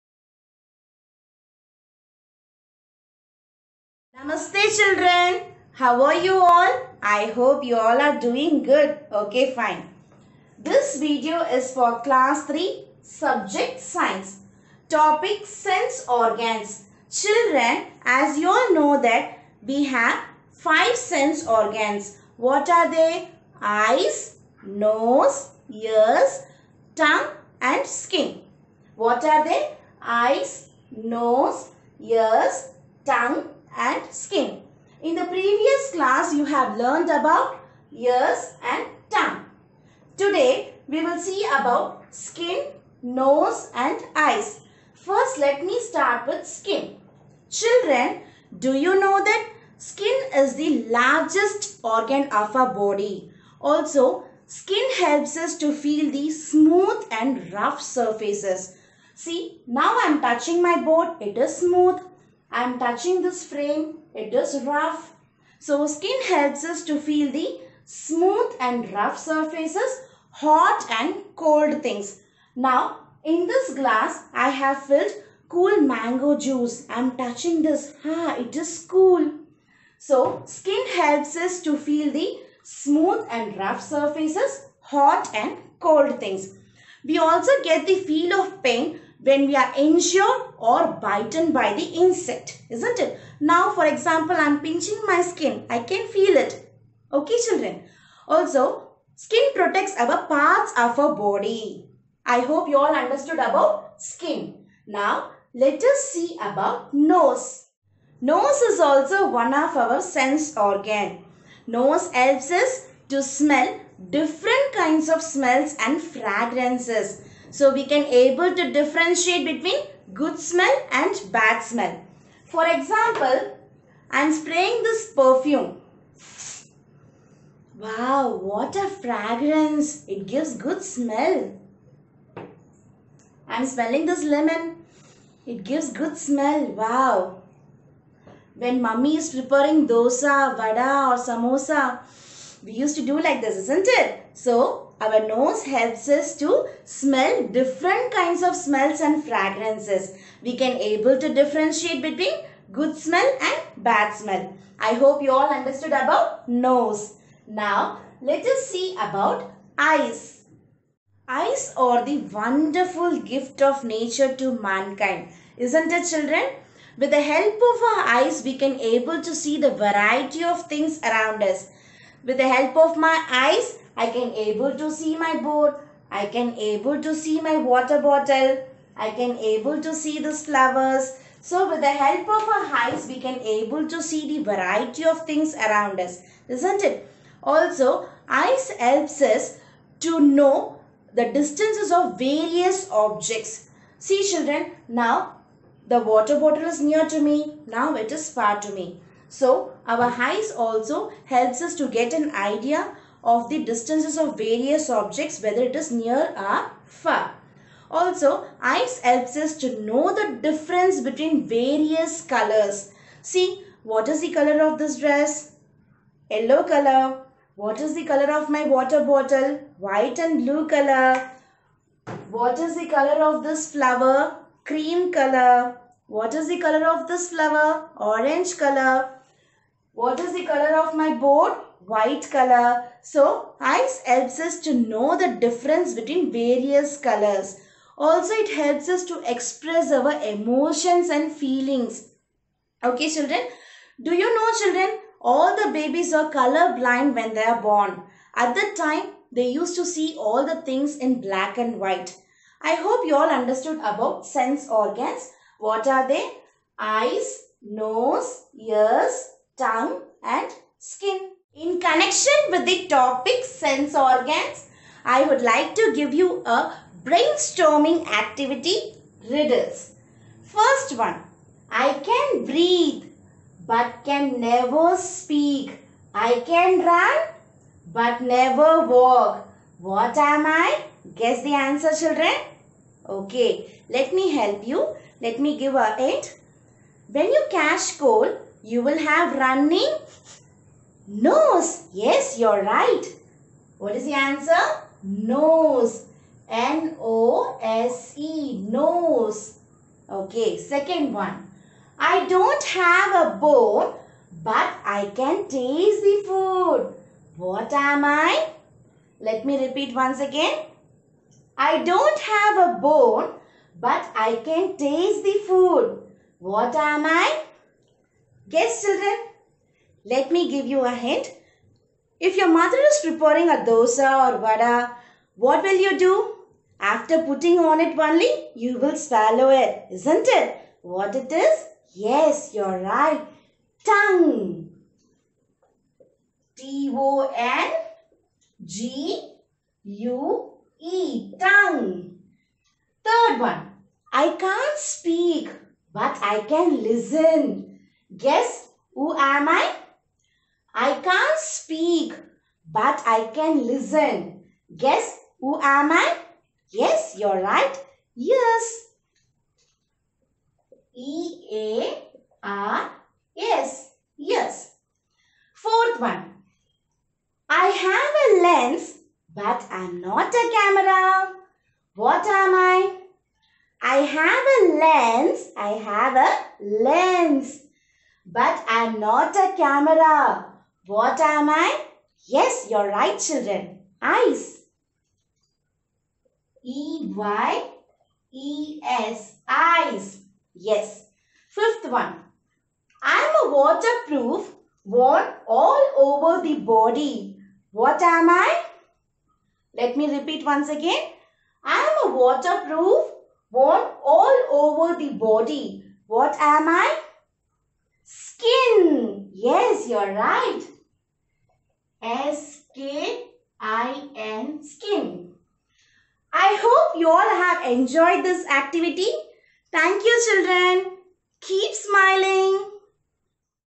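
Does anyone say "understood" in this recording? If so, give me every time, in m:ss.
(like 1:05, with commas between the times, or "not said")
1:42, 2:35, 4:13.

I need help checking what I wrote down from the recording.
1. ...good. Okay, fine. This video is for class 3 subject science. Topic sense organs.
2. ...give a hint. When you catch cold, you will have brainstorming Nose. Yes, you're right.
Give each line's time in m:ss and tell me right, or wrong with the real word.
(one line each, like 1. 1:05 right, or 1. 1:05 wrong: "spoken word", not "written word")
1. 0:08 right
2. 4:45 wrong: "running", not "brainstorming".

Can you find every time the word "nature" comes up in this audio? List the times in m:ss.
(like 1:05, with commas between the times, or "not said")
2:43.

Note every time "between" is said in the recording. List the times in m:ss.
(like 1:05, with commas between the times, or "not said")
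1:59, 2:32, 3:31, 3:55.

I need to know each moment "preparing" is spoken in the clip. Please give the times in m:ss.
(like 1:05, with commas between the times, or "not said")
2:19, 5:23.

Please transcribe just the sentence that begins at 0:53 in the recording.
Also, skin helps us to feel the smooth and rough surfaces.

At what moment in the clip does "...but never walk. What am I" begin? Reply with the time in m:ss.
4:37.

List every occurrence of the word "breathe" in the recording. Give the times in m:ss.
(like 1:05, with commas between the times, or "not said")
4:32.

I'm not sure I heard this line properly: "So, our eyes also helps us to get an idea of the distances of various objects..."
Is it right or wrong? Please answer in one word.
right.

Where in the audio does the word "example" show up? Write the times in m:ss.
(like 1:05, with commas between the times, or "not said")
1:33, 2:02.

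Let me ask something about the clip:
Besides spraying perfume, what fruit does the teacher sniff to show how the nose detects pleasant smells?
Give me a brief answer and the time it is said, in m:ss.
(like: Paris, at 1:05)
lemon, at 2:14.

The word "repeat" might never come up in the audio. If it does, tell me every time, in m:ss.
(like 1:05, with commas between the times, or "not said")
5:09, 6:40.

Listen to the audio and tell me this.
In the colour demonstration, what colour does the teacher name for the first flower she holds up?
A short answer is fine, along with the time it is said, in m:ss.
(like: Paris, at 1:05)
cream, at 3:44.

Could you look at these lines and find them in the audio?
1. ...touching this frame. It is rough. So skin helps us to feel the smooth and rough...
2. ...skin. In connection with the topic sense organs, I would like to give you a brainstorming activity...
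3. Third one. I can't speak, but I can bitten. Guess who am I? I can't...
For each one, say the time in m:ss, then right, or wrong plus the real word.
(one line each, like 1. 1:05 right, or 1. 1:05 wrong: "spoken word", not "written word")
1. 1:02 right
2. 4:20 right
3. 5:43 wrong: "listen", not "bitten".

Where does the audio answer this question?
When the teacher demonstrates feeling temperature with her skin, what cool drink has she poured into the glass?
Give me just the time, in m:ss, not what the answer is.
1:15.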